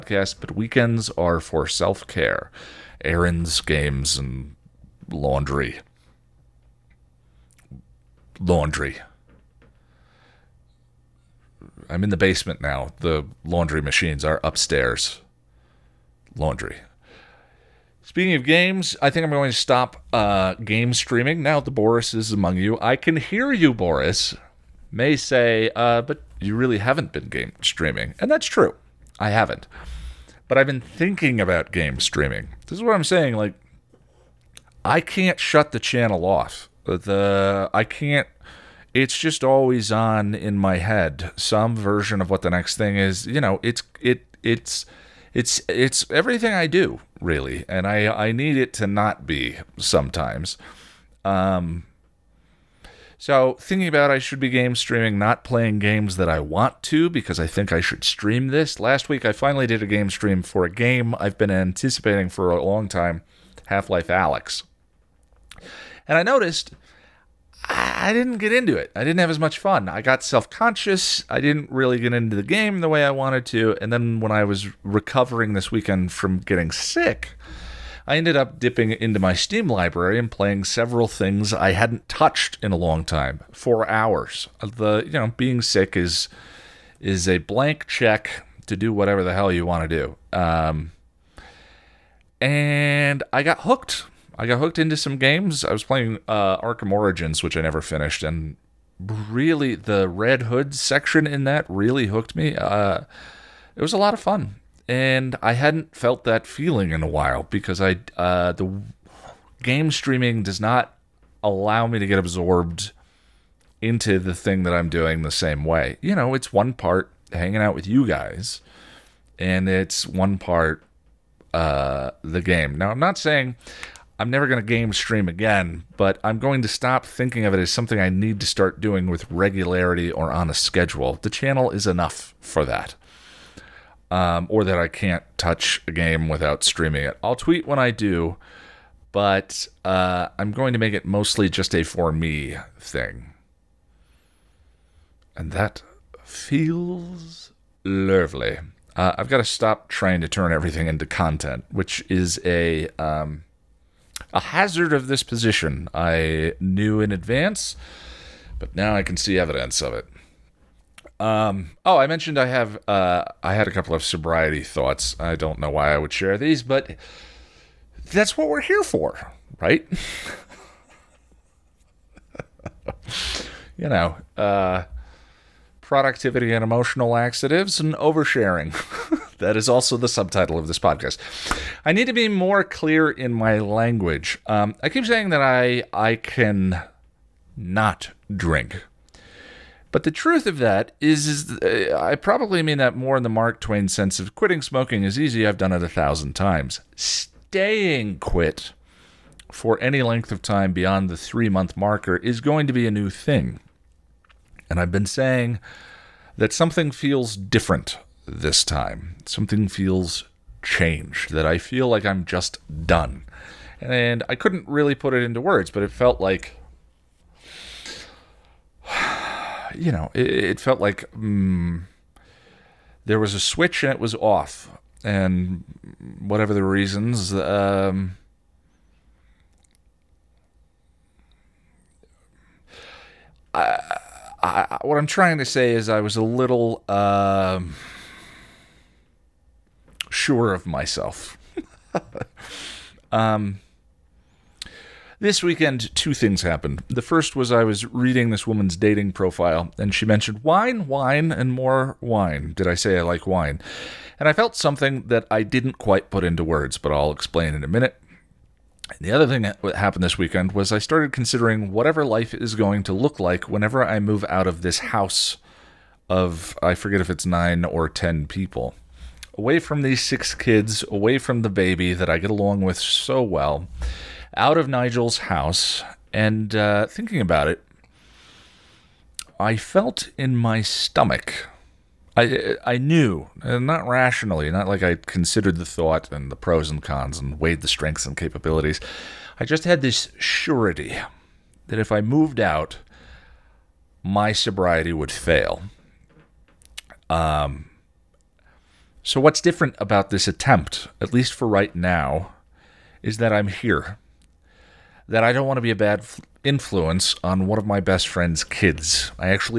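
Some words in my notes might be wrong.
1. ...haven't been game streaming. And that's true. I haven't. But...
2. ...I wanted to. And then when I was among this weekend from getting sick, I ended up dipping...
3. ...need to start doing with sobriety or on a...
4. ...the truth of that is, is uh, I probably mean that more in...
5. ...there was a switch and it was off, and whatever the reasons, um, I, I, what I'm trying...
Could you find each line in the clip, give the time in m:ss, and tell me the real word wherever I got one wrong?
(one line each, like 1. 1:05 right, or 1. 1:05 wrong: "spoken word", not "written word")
1. 0:26 right
2. 1:13 wrong: "recovering", not "among"
3. 2:08 wrong: "regularity", not "sobriety"
4. 3:10 right
5. 3:43 right.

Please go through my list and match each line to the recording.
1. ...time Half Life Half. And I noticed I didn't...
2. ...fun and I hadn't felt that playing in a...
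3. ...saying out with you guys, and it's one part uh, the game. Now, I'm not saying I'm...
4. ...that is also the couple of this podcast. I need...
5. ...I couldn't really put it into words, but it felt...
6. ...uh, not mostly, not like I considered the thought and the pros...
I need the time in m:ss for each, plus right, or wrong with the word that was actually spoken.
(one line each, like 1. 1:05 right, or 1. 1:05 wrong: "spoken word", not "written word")
1. 1:02 wrong: "Alyx", not "Half"
2. 1:44 wrong: "feeling", not "playing"
3. 1:57 wrong: "hanging", not "saying"
4. 2:59 wrong: "subtitle", not "couple"
5. 3:34 right
6. 4:43 wrong: "rationally", not "mostly".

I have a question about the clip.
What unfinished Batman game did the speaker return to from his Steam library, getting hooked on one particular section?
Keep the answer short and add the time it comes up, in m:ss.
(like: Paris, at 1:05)
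Arkham Origins, at 1:36.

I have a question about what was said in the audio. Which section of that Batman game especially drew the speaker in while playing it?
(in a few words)
Red Hood.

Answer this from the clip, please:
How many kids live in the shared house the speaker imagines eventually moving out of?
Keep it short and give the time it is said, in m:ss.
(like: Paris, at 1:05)
6, at 4:30.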